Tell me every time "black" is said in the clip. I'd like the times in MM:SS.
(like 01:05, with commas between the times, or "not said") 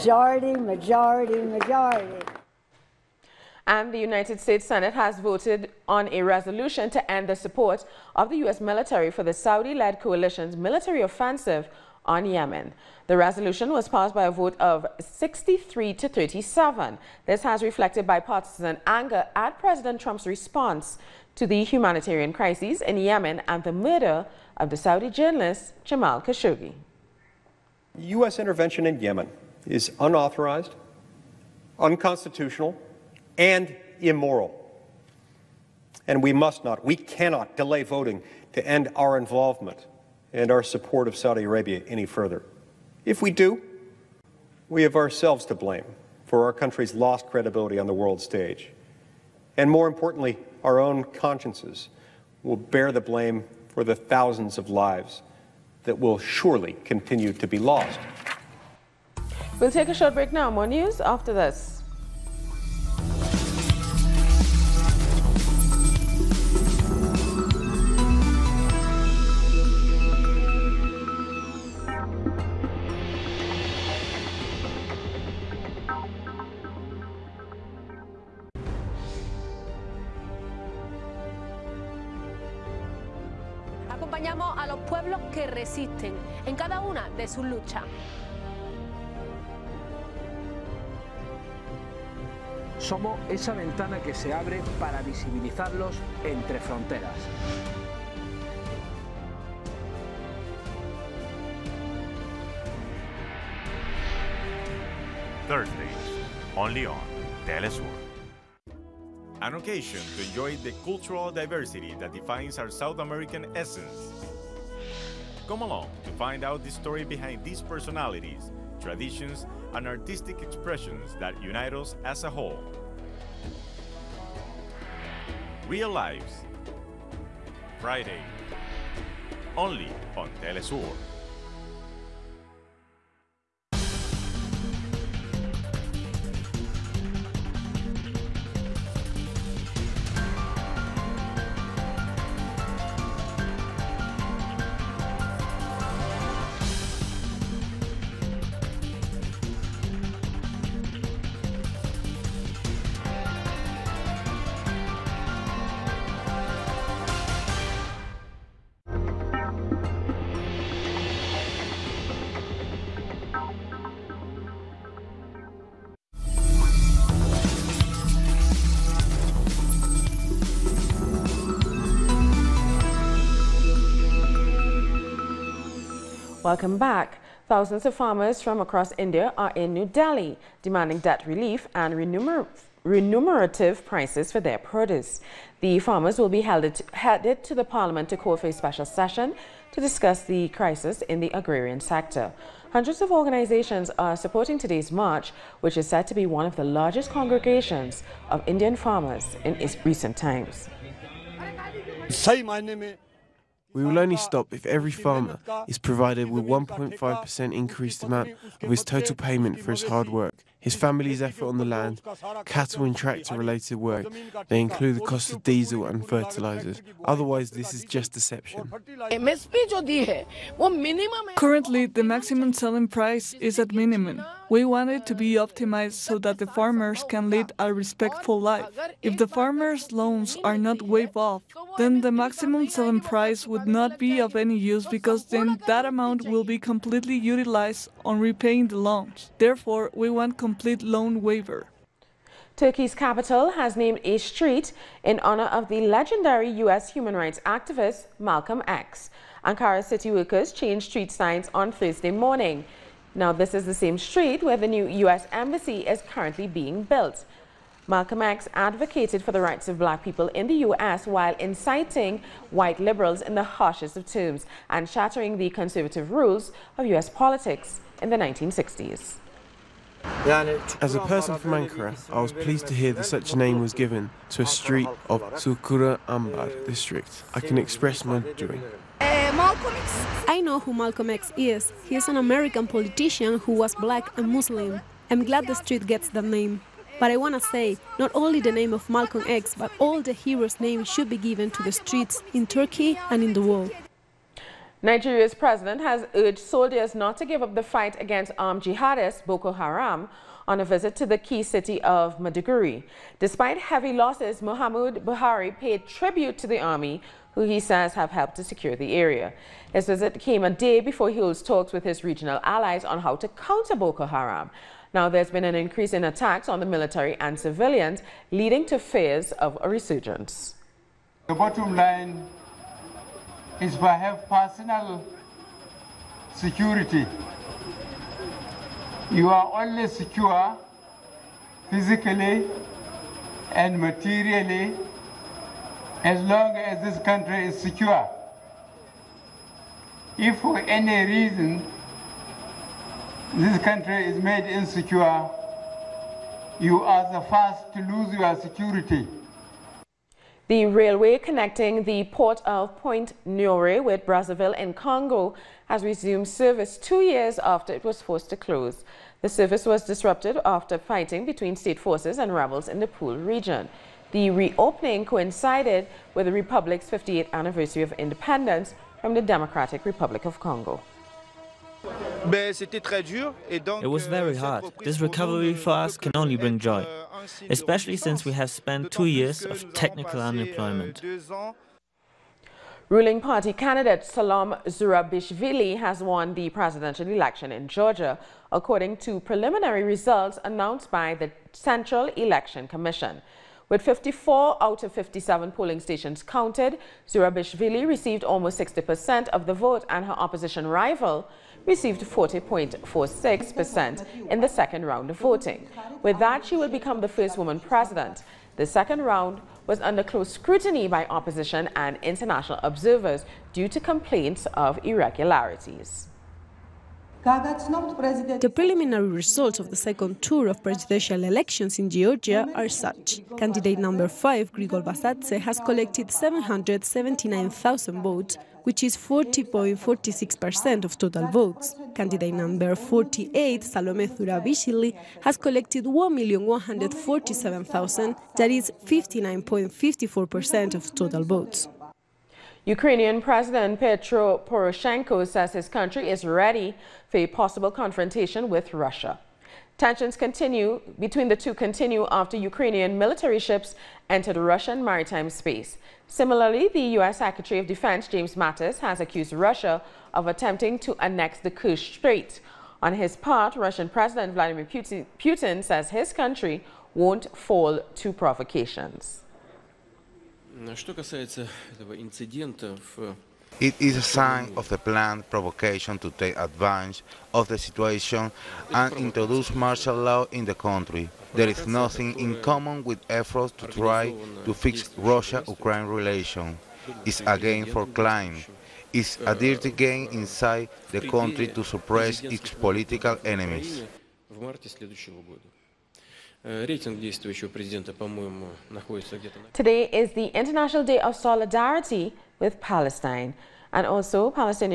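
04:19, 04:43.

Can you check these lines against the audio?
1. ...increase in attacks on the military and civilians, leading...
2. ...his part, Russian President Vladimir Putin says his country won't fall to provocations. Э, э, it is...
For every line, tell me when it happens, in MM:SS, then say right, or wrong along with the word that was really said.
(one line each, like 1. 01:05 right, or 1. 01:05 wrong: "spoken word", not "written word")
1. 05:15 right
2. 07:42 right.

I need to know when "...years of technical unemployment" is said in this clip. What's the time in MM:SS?
06:19.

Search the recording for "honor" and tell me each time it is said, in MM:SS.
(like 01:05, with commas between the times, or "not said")
04:05.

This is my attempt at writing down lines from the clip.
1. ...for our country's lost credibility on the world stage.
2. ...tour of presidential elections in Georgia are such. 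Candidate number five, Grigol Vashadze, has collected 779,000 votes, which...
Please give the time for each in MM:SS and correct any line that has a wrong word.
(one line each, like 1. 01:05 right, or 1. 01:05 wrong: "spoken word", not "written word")
1. 00:46 right
2. 07:00 right.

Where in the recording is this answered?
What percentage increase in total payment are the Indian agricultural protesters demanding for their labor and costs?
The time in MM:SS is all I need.
03:26.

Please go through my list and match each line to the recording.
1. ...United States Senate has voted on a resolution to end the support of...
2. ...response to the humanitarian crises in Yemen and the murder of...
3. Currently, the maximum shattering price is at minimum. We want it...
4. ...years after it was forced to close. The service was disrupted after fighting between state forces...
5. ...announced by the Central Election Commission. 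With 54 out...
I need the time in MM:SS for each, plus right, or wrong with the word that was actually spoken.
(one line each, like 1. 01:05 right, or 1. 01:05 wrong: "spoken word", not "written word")
1. 00:03 right
2. 00:20 right
3. 03:41 wrong: "selling", not "shattering"
4. 05:57 right
5. 06:30 right.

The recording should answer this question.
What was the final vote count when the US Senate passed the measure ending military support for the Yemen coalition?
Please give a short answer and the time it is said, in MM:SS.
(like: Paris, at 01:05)
63 to 37, at 00:14.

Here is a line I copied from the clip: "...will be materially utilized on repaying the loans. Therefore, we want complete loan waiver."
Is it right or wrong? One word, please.
wrong.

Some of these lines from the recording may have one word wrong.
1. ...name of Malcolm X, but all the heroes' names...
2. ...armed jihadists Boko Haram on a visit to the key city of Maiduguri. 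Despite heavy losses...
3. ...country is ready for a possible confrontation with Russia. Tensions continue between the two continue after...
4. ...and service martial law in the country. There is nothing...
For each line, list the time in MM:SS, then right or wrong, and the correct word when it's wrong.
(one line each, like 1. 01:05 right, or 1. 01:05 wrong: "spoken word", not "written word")
1. 04:48 right
2. 04:58 right
3. 07:25 right
4. 07:58 wrong: "introduce", not "service".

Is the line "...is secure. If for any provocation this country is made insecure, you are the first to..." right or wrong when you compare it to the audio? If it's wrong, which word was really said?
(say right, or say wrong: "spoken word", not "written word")
wrong: "reason", not "provocation".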